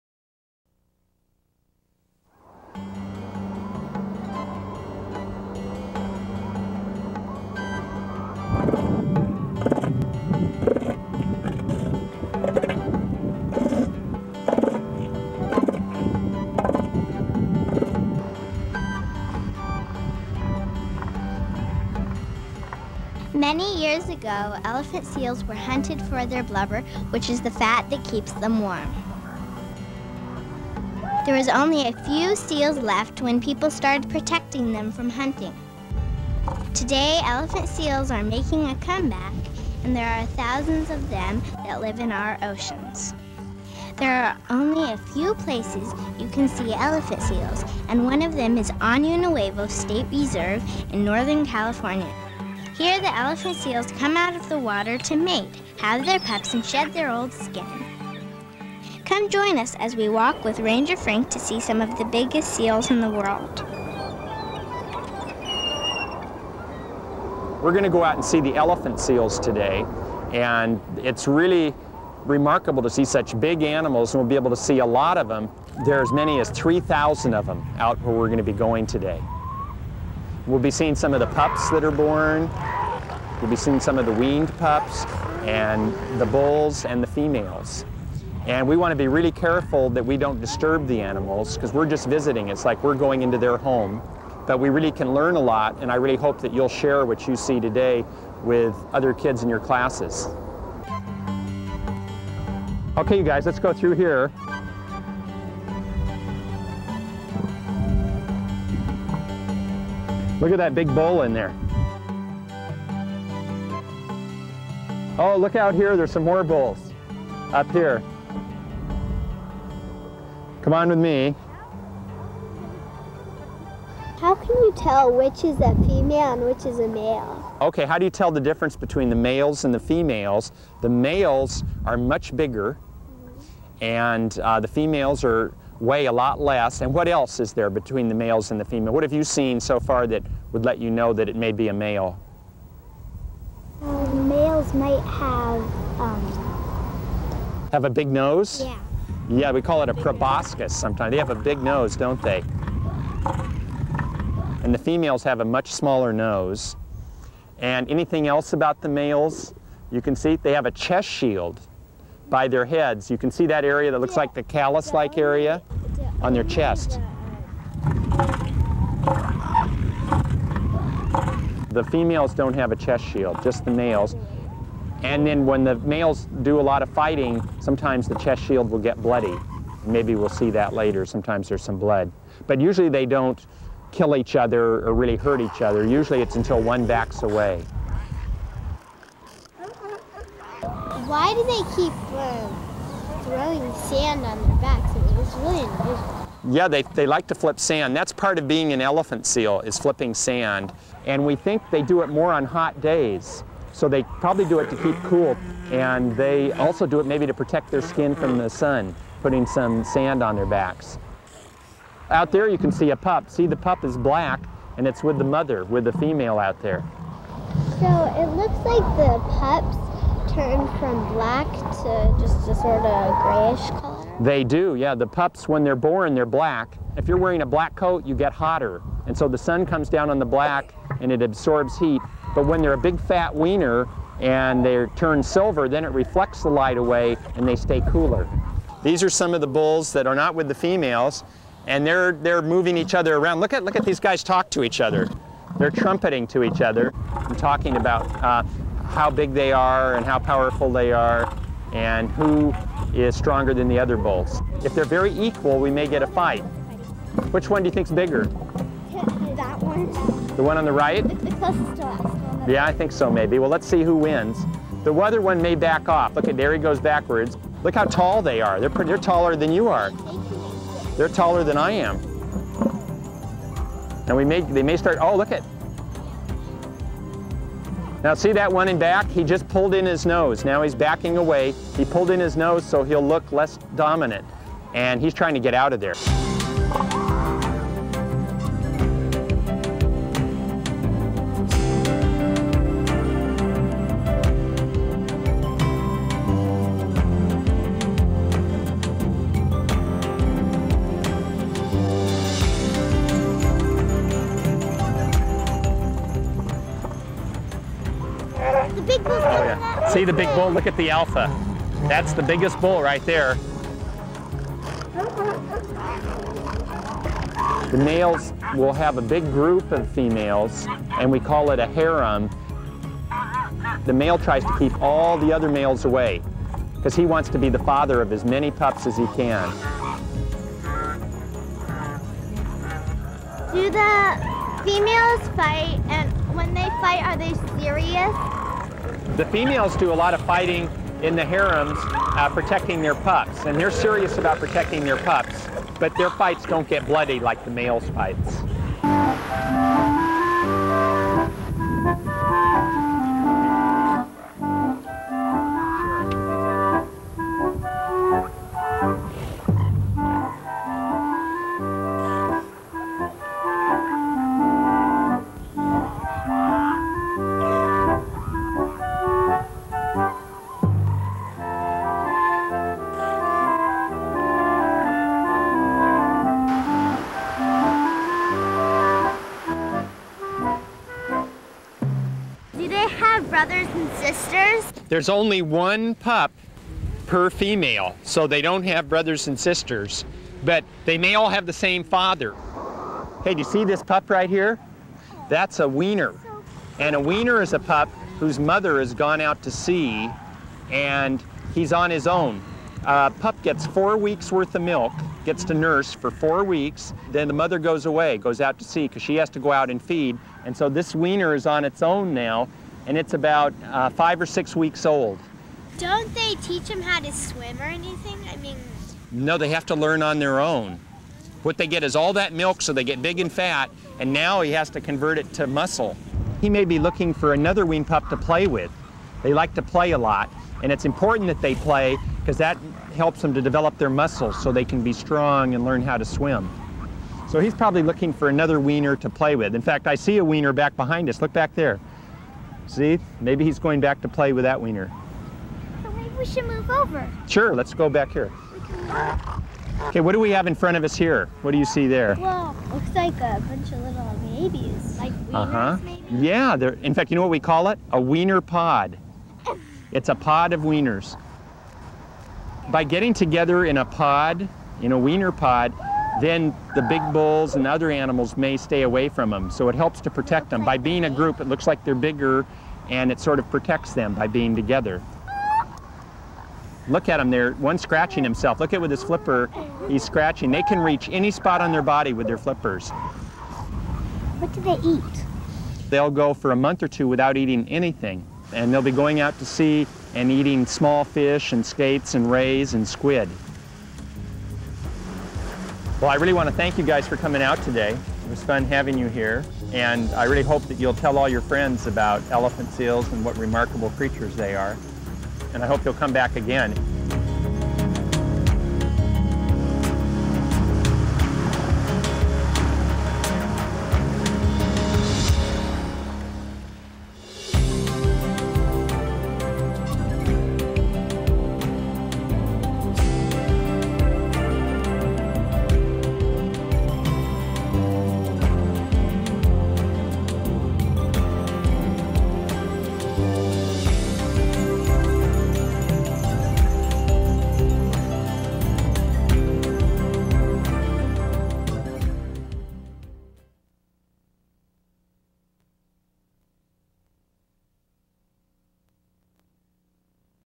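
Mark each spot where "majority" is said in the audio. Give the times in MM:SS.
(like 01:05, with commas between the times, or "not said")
not said.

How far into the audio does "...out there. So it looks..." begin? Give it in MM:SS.
03:36.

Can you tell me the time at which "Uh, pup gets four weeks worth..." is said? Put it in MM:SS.
06:42.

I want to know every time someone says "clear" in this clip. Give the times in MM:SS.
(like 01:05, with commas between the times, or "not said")
not said.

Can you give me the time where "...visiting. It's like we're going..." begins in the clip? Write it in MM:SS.
01:32.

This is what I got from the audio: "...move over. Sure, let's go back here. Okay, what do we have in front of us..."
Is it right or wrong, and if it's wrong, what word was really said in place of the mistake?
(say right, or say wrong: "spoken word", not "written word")
right.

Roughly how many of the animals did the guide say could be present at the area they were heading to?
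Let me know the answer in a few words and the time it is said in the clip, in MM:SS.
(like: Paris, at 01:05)
3,000, at 01:16.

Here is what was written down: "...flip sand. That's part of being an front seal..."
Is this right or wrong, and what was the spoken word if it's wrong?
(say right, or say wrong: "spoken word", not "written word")
wrong: "elephant", not "front".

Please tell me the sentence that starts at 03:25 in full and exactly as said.
And they also do it maybe to protect their skin from the sun, putting some sand on their backs.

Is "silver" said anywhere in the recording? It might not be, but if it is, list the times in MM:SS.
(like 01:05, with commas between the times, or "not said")
03:55.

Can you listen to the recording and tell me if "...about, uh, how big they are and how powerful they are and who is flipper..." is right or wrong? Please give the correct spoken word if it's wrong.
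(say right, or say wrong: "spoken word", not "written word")
wrong: "stronger", not "flipper".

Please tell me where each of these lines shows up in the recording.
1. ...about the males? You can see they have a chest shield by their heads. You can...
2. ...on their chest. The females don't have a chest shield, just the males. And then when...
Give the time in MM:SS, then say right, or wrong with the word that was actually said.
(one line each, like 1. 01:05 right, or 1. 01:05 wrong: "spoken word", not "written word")
1. 02:38 right
2. 02:46 right.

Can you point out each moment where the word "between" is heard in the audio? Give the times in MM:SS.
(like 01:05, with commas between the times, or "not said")
02:08, 02:17.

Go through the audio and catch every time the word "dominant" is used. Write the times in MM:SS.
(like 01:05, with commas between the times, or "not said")
04:43.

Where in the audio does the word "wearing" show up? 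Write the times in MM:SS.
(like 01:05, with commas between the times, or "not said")
03:47.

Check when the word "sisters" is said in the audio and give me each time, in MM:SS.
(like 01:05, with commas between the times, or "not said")
06:23, 06:29.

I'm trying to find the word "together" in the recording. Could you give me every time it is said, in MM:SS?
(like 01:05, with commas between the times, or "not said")
07:43, 07:54.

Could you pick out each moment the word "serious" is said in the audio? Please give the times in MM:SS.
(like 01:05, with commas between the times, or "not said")
05:37, 05:43.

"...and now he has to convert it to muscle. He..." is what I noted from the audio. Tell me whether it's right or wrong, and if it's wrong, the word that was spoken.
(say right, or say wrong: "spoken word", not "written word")
right.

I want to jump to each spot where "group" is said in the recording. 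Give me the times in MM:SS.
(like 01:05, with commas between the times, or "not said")
05:19, 07:51.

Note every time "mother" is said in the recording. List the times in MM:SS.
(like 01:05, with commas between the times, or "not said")
03:35, 06:38, 06:47.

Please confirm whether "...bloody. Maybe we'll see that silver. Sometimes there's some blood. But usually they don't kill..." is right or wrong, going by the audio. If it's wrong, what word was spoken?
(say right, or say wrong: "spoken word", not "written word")
wrong: "later", not "silver".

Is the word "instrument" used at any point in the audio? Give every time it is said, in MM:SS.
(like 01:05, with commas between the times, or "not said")
not said.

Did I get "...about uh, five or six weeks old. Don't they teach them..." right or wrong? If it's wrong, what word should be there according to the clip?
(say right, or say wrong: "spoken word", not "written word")
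right.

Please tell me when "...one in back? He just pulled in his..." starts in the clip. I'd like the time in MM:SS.
04:38.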